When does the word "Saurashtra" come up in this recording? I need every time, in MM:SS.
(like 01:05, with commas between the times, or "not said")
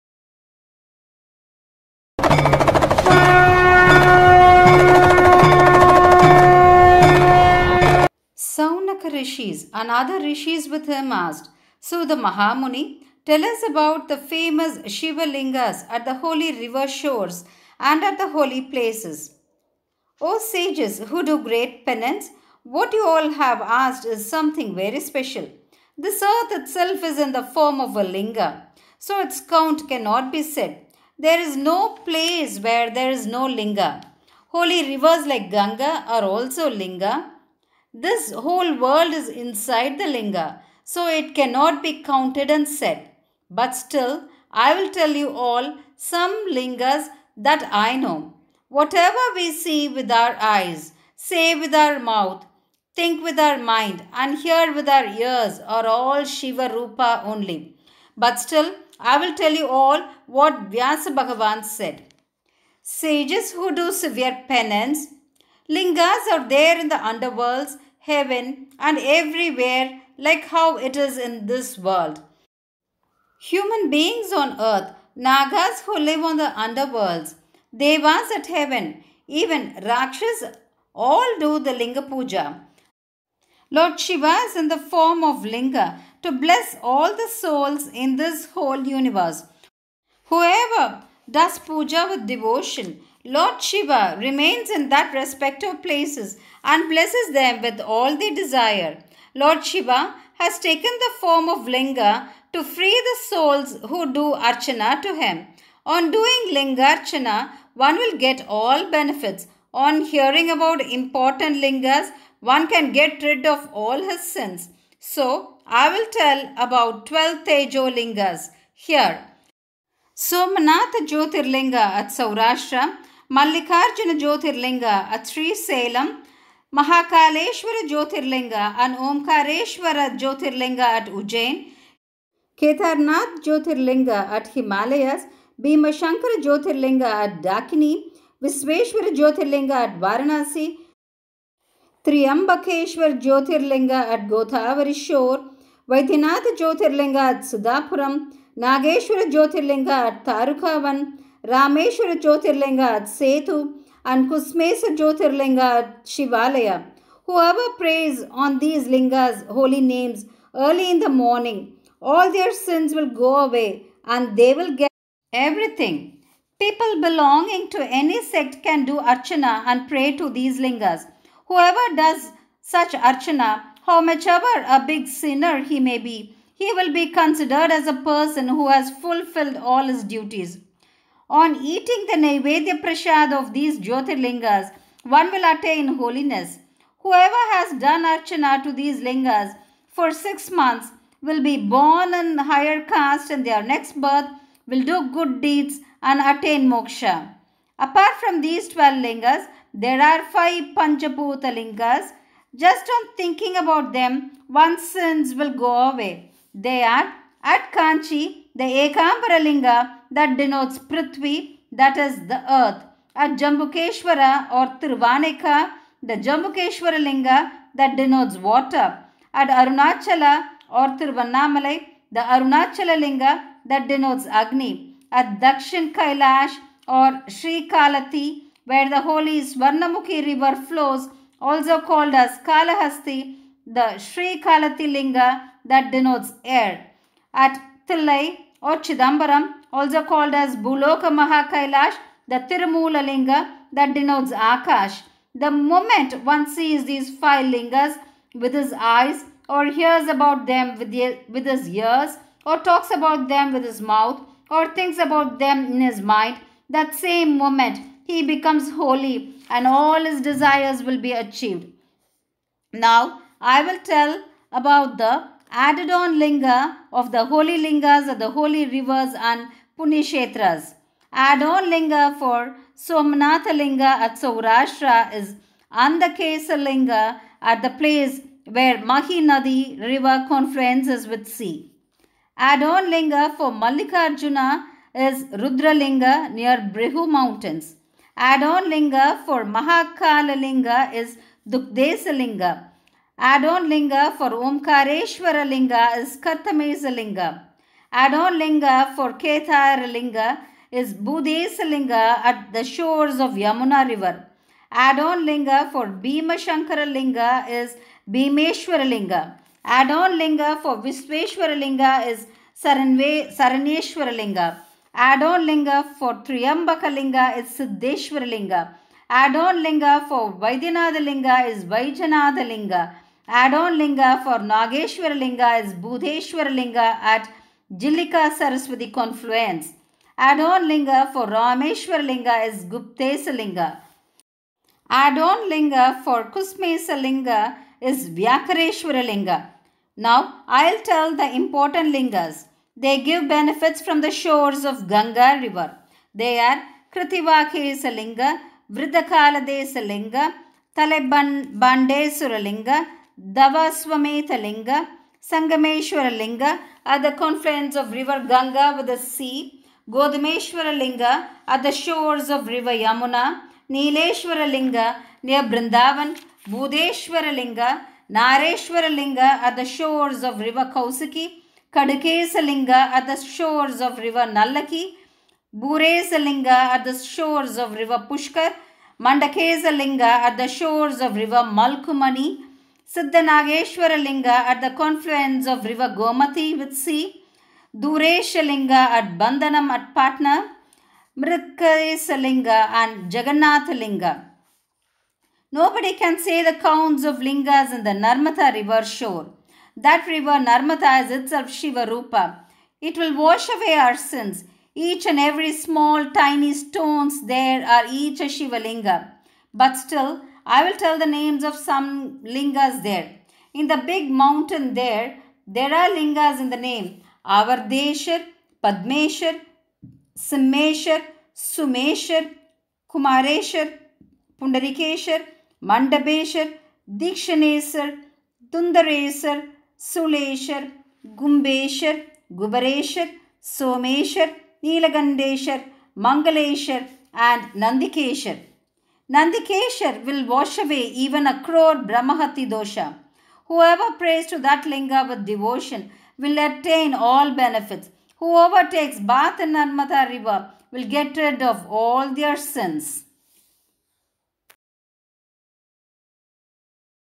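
02:02, 04:34.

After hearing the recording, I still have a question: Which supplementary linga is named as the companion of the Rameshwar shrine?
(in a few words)
Guptesa linga.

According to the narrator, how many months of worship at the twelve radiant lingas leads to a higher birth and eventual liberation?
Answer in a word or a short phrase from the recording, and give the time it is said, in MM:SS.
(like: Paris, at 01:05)
6, at 03:10.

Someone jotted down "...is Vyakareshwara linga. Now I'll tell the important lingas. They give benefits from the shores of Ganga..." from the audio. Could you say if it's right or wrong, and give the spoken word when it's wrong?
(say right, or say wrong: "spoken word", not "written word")
right.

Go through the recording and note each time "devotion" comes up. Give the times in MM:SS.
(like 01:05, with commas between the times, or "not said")
01:32, 07:25.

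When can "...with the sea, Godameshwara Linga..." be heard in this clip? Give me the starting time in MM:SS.
05:58.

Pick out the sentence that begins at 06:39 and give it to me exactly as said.
That river Narmatha is itself Shiva Rupa.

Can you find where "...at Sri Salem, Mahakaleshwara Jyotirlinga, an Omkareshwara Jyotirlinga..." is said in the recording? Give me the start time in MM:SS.
02:05.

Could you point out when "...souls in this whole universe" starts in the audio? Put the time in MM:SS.
01:27.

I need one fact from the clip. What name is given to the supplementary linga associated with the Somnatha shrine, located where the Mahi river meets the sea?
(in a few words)
Andakesa linga.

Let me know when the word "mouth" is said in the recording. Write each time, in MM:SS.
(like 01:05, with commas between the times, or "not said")
00:51, 04:13.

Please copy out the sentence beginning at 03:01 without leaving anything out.
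On eating the Naivedya Prashad of these Jyotirlingas, one will attain holiness.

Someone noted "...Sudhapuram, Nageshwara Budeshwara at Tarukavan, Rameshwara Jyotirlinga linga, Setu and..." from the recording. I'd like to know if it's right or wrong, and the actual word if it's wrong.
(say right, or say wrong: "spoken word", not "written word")
wrong: "Jyotirlinga", not "Budeshwara".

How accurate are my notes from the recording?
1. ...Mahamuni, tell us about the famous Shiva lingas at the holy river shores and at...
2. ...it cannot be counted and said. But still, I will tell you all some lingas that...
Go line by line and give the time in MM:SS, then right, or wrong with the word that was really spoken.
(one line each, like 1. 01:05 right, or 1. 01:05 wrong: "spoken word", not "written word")
1. 00:12 right
2. 00:41 right.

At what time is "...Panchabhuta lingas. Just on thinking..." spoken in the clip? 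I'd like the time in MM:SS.
03:20.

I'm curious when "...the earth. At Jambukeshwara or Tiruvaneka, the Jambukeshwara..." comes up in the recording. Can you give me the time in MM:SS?
03:32.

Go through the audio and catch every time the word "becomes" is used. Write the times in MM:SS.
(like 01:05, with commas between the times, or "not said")
04:18.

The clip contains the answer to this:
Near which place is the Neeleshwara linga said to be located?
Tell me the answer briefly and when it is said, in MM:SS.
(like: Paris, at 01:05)
Brindavan, at 06:05.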